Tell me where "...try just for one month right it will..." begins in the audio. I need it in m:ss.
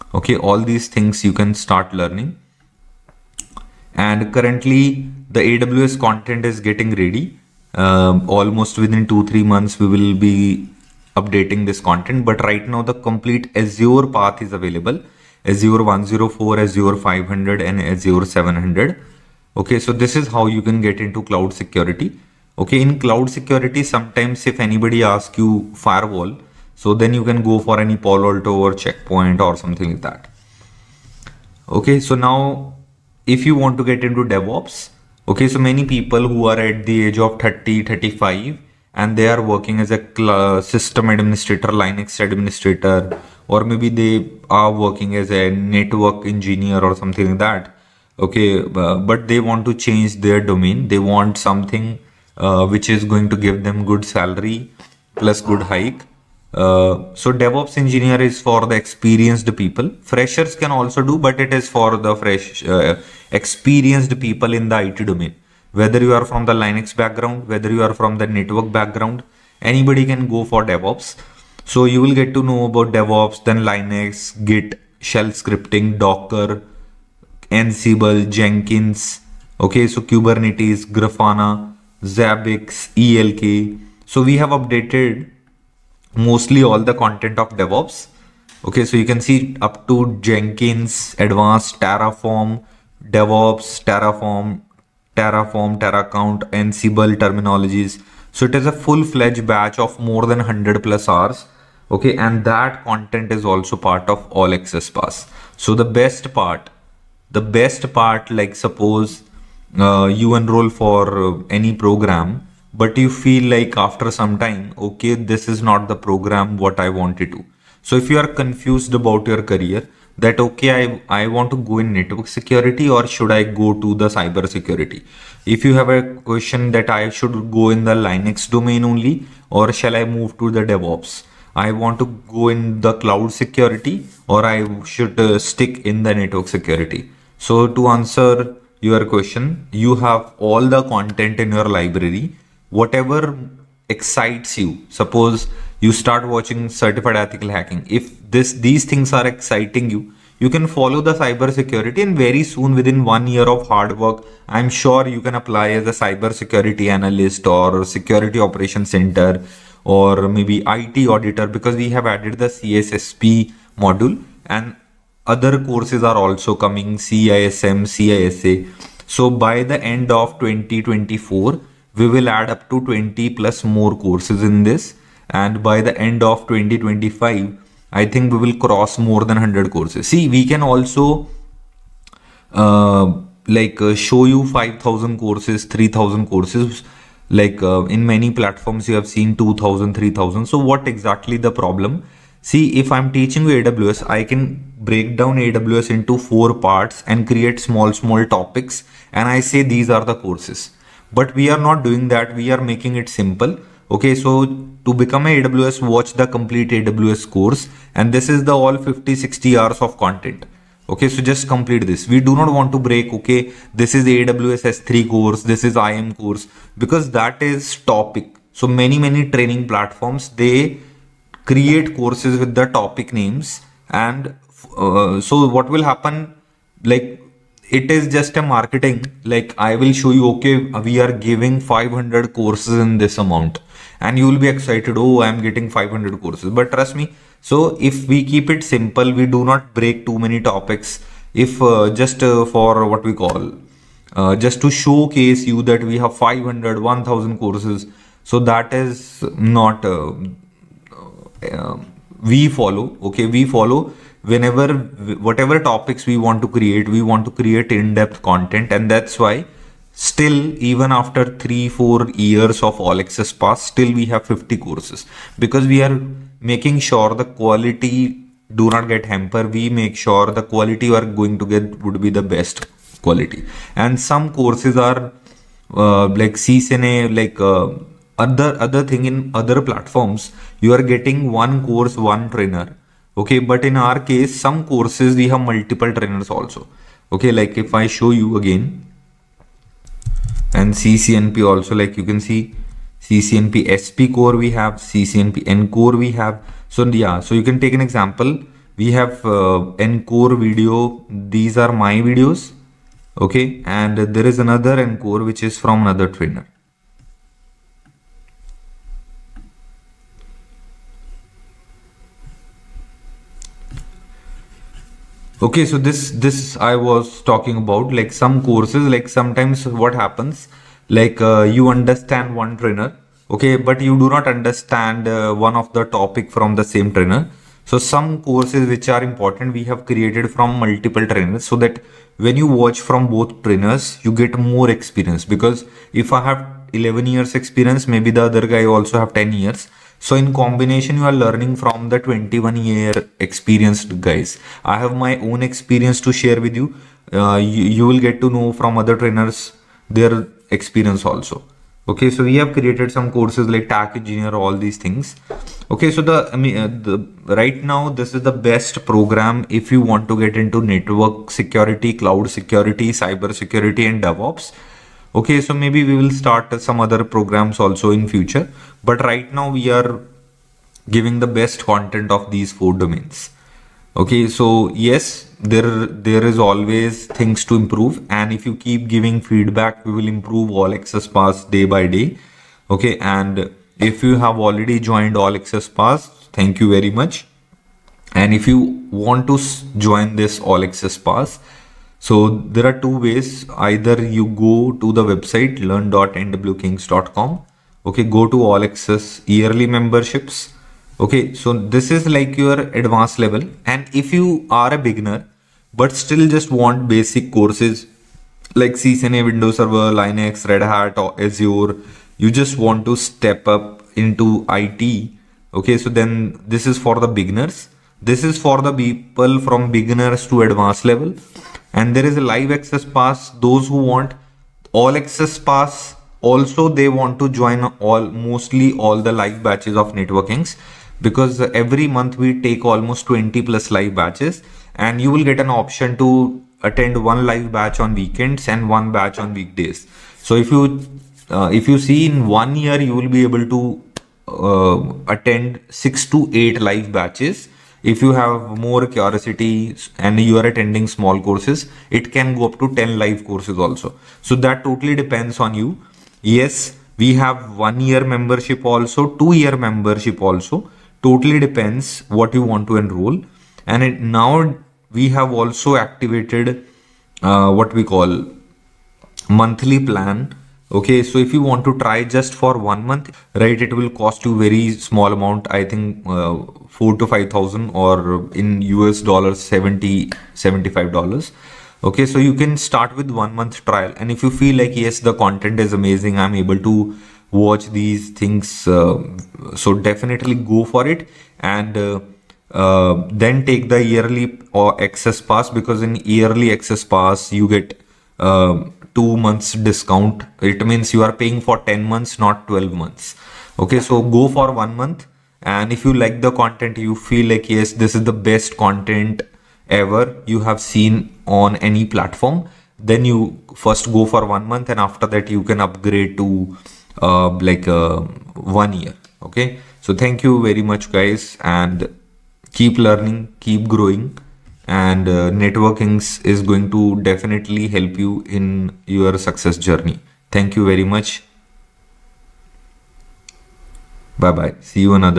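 7:51.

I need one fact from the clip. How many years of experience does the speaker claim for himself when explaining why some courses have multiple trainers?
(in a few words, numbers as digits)
11.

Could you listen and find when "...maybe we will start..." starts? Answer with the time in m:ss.
6:05.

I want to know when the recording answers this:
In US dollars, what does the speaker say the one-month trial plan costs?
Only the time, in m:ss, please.
7:59.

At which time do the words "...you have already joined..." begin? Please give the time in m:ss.
6:24.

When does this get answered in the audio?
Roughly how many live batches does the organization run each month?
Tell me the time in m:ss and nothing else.
7:13.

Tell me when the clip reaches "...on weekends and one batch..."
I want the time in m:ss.
7:17.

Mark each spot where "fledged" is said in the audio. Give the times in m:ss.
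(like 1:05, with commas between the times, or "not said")
1:38.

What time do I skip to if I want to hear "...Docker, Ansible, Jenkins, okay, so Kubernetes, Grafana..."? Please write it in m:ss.
1:15.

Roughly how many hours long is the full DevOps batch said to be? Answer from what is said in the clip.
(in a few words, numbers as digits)
100+ hours.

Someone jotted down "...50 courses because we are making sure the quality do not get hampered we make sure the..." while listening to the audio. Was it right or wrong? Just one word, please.
right.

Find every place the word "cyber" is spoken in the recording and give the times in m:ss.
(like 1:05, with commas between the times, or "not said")
2:04, 2:31, 2:35, 6:03.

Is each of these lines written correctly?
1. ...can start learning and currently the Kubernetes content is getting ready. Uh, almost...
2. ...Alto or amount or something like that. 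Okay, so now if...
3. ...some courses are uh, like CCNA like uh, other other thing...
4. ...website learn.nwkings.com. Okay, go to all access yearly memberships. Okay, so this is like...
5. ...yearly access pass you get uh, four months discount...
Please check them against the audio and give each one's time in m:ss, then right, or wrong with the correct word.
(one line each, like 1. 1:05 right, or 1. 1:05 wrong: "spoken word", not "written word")
1. 0:01 wrong: "AWS", not "Kubernetes"
2. 0:28 wrong: "checkpoint", not "amount"
3. 4:34 right
4. 6:35 right
5. 8:16 wrong: "two", not "four".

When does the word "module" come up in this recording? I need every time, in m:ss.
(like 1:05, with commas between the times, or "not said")
2:43.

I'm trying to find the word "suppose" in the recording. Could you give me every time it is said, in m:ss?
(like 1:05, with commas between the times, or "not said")
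1:48, 2:24.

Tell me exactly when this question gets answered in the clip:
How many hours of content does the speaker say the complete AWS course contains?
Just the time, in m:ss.
3:28.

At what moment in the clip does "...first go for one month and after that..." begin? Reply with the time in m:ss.
8:33.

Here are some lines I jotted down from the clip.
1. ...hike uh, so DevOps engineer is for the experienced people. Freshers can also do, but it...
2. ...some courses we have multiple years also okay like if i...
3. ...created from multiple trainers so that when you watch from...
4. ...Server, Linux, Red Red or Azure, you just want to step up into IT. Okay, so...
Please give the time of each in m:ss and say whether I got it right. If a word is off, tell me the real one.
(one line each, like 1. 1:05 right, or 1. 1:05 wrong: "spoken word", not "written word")
1. 0:55 right
2. 4:44 wrong: "trainers", not "years"
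3. 5:29 right
4. 6:49 wrong: "Hat", not "Red".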